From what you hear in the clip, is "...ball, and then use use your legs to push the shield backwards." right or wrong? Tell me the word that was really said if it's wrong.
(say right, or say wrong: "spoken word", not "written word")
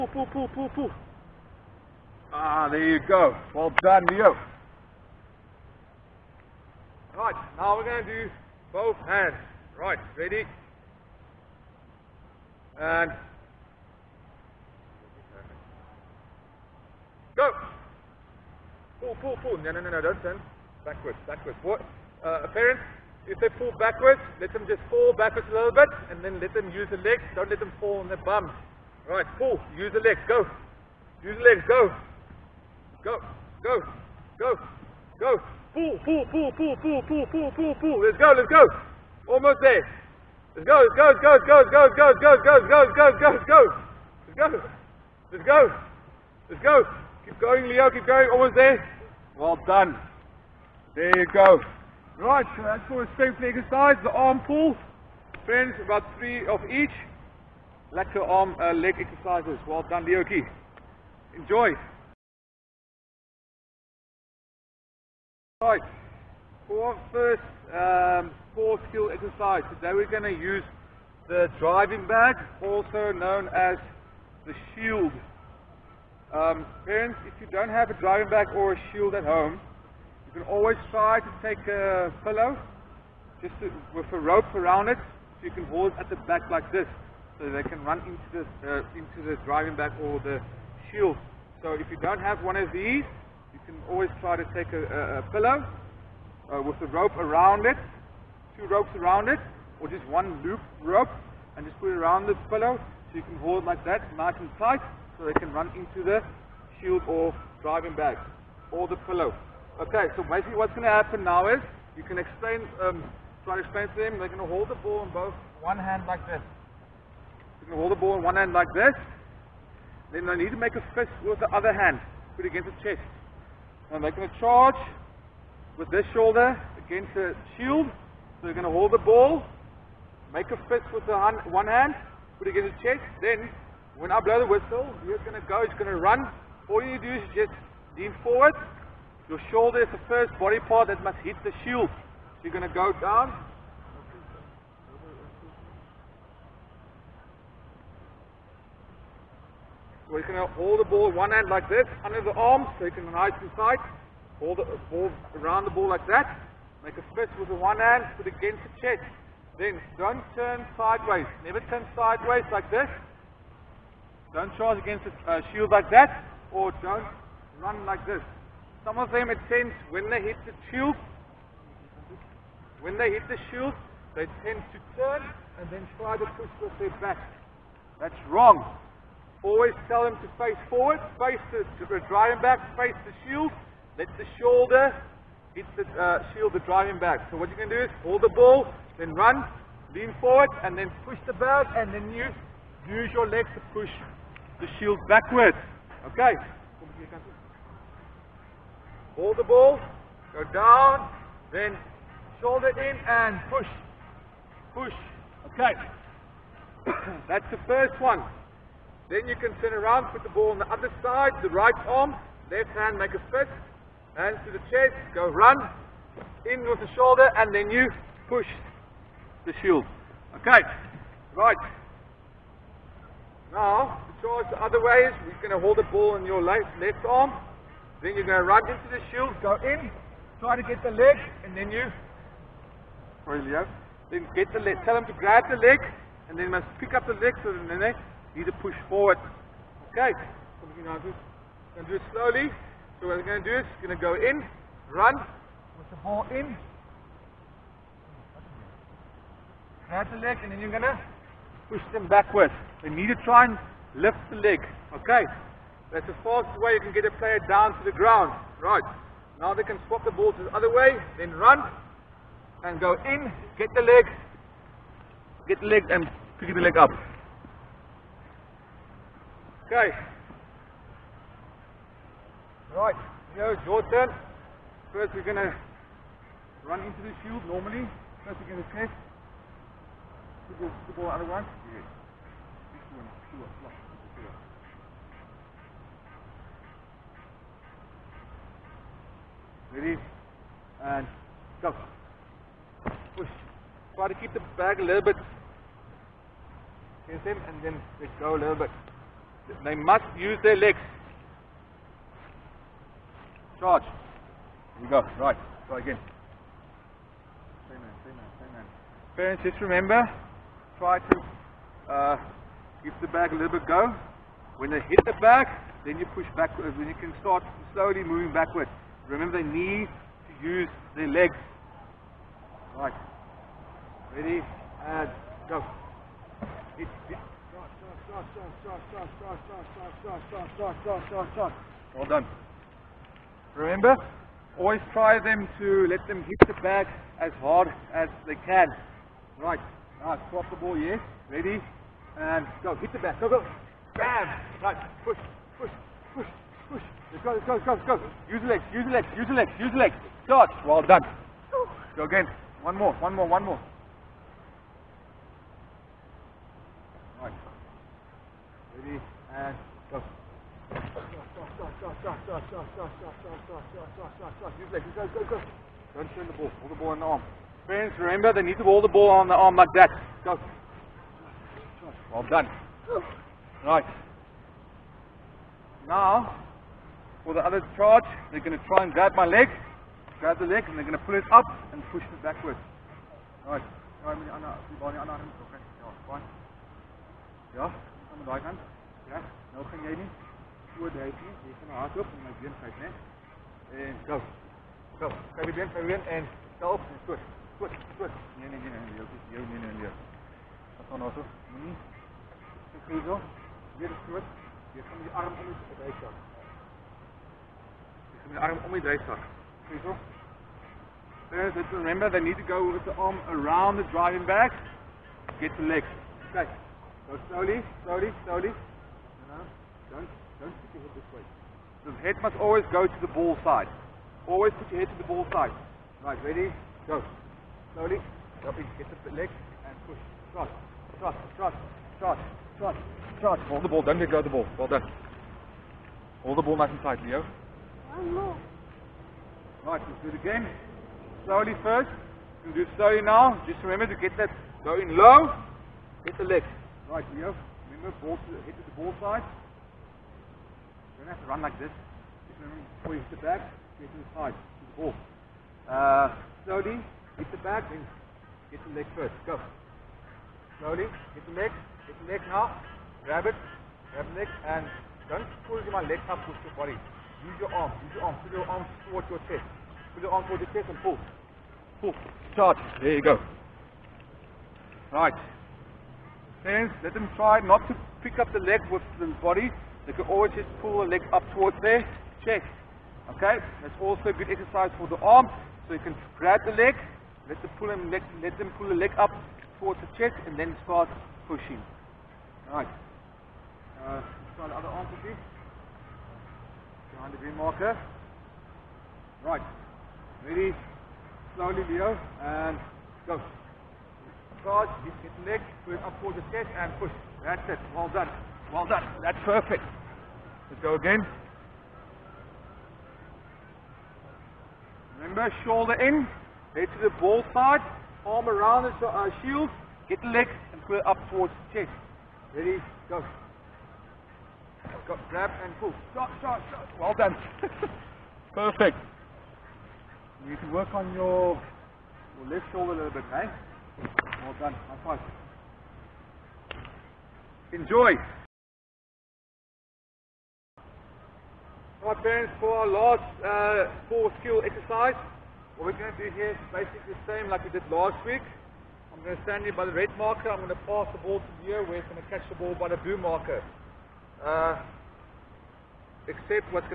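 right.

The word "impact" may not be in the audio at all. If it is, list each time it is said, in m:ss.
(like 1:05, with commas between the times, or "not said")
not said.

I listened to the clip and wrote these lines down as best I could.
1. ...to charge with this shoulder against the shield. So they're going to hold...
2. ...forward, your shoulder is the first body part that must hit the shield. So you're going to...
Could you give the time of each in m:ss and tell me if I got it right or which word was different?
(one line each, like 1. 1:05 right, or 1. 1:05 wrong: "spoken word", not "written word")
1. 2:04 right
2. 2:18 right.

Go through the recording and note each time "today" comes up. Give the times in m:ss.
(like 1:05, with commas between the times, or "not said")
1:09.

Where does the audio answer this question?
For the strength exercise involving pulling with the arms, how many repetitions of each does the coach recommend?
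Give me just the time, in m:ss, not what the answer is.
0:55.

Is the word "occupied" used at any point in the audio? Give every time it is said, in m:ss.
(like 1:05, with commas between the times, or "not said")
not said.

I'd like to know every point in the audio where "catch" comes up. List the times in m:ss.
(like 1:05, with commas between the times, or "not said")
9:12.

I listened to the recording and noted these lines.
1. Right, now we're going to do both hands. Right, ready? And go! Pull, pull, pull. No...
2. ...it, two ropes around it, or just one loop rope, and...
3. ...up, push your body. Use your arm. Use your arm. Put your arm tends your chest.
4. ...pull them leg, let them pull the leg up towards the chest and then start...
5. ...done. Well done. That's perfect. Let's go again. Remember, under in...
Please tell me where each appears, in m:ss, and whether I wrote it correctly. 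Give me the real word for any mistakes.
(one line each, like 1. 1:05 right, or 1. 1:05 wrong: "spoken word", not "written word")
1. 0:07 right
2. 1:37 right
3. 7:46 wrong: "towards", not "tends"
4. 8:07 right
5. 8:27 wrong: "shoulder", not "under".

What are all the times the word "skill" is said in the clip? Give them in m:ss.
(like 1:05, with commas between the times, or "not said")
1:08, 9:04.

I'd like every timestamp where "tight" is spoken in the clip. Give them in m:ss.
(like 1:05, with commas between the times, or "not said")
1:44, 7:16.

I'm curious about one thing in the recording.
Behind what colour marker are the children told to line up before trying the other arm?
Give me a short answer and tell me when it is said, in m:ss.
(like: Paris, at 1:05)
Green, at 8:17.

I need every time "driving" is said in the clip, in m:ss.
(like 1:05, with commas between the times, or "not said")
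1:11, 1:17, 1:29, 1:47, 3:02, 3:06, 6:53.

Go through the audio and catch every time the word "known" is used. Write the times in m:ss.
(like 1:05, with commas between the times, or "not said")
1:13.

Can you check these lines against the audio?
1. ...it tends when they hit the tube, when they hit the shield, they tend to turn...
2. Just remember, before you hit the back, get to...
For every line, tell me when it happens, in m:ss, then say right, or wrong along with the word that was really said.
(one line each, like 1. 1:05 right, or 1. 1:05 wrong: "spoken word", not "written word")
1. 2:49 right
2. 7:31 right.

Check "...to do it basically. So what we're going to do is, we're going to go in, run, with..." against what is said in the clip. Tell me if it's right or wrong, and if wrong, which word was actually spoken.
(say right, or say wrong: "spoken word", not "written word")
wrong: "slowly", not "basically".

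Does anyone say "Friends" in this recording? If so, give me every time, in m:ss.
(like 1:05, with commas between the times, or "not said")
0:55, 6:07.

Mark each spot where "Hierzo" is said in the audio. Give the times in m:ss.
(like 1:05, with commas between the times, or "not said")
6:49.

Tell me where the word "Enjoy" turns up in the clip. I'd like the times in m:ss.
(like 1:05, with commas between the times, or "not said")
1:01, 8:57.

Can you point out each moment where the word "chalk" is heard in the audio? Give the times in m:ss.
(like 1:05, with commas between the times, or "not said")
not said.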